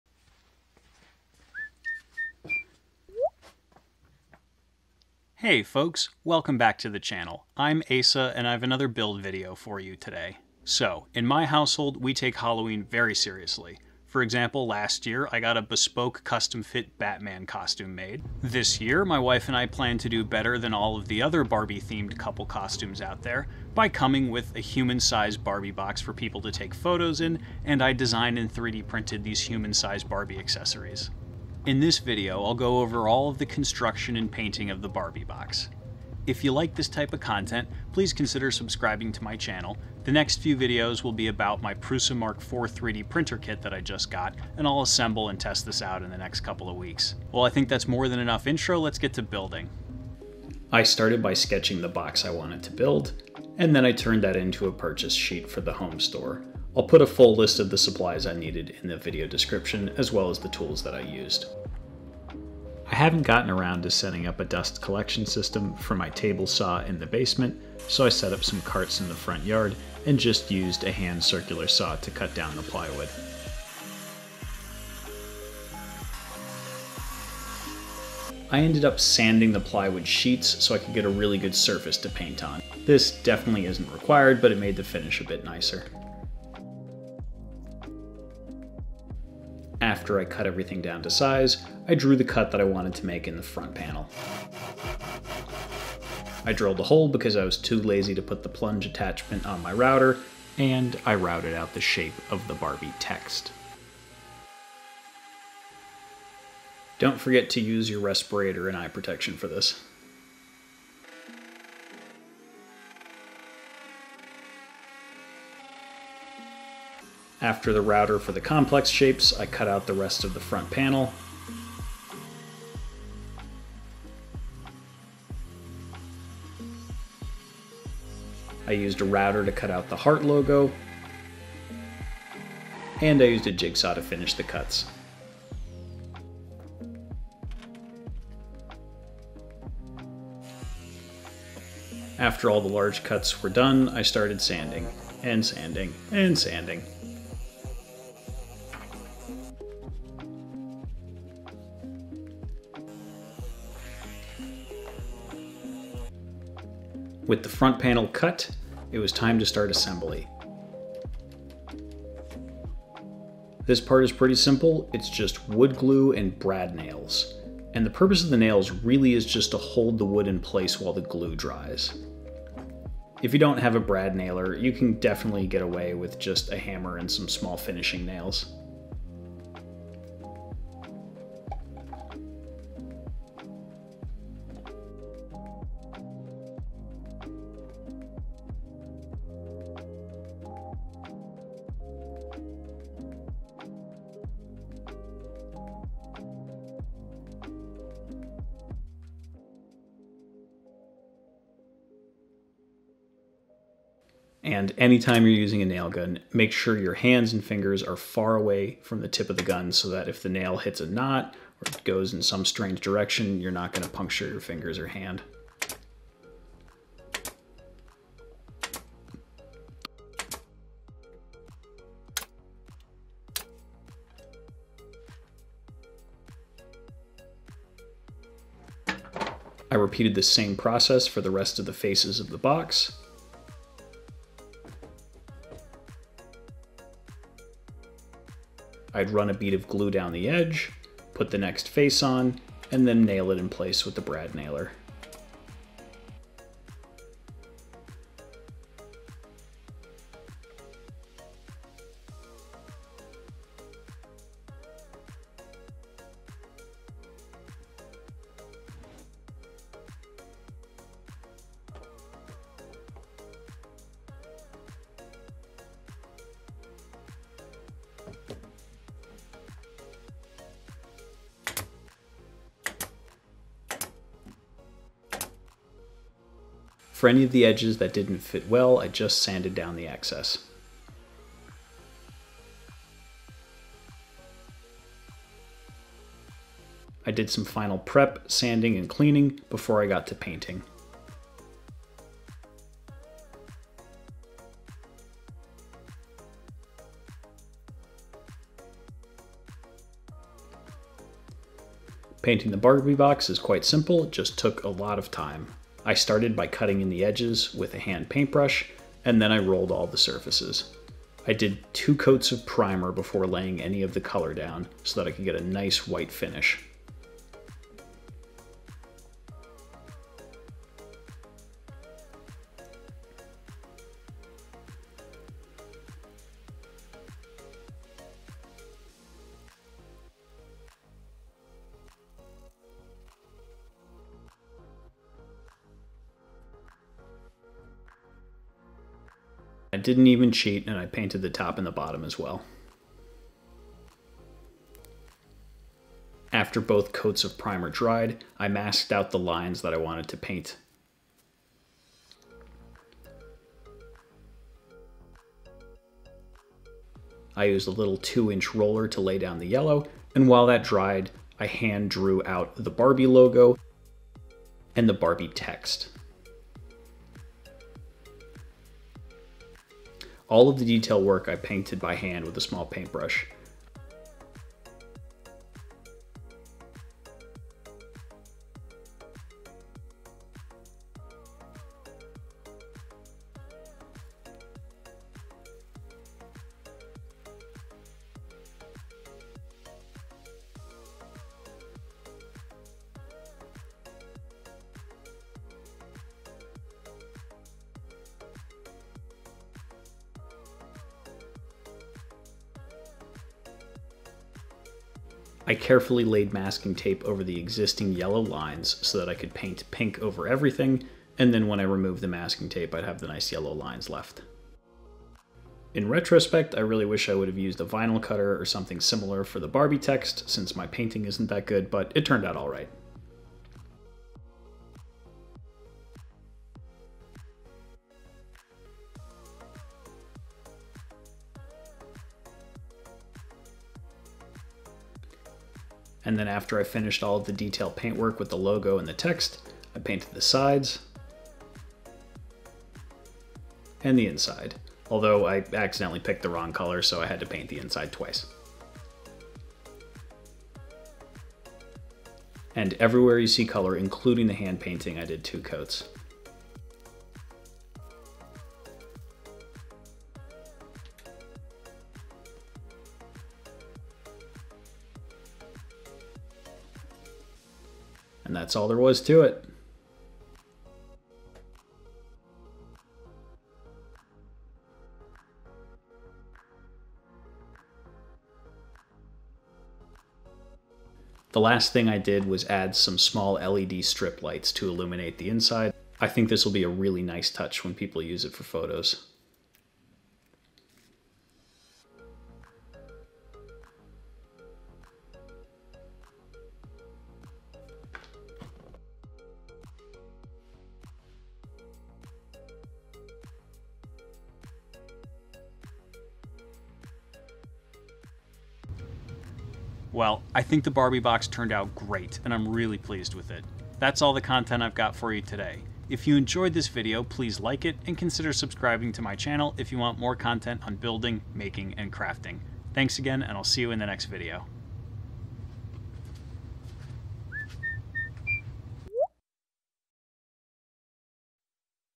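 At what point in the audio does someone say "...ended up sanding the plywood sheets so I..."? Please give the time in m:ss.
1:18.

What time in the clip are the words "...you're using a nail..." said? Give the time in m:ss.
3:25.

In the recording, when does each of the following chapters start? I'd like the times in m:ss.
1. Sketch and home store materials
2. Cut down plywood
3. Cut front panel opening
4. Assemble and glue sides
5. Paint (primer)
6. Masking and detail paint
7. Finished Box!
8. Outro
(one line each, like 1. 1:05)
1. 0:50
2. 1:04
3. 1:29
4. 2:36
5. 5:02
6. 5:45
7. 7:39
8. 8:28.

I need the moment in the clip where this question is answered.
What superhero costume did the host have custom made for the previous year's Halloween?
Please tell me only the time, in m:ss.
0:16.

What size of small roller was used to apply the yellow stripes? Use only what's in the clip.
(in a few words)
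2-inch.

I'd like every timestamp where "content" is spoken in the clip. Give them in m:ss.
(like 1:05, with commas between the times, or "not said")
0:37, 8:34, 8:40.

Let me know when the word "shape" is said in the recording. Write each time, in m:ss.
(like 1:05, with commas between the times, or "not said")
1:41, 1:58.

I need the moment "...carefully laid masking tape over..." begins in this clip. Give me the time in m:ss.
6:45.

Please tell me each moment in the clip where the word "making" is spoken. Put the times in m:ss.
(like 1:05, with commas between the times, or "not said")
8:41.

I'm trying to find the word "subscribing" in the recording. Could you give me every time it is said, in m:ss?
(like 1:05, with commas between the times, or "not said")
0:38, 8:38.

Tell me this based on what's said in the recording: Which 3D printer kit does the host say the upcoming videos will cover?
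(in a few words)
Prusa Mark IV.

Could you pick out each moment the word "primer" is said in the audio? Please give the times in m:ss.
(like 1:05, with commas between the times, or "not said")
5:12, 5:47.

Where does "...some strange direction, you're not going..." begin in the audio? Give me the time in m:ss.
3:32.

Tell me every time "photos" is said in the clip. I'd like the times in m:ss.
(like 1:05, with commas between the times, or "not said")
0:26, 8:08.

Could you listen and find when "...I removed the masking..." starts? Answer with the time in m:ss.
6:51.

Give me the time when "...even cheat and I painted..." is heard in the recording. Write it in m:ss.
5:40.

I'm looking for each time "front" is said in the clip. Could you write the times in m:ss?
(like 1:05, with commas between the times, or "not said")
1:09, 1:33, 2:00, 2:37.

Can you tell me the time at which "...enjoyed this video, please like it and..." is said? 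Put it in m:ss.
8:36.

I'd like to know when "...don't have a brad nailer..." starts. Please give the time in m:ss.
2:53.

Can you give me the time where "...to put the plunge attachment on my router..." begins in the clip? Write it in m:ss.
1:38.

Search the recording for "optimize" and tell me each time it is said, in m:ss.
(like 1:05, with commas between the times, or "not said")
not said.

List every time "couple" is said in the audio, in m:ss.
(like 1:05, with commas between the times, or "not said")
0:22, 0:46.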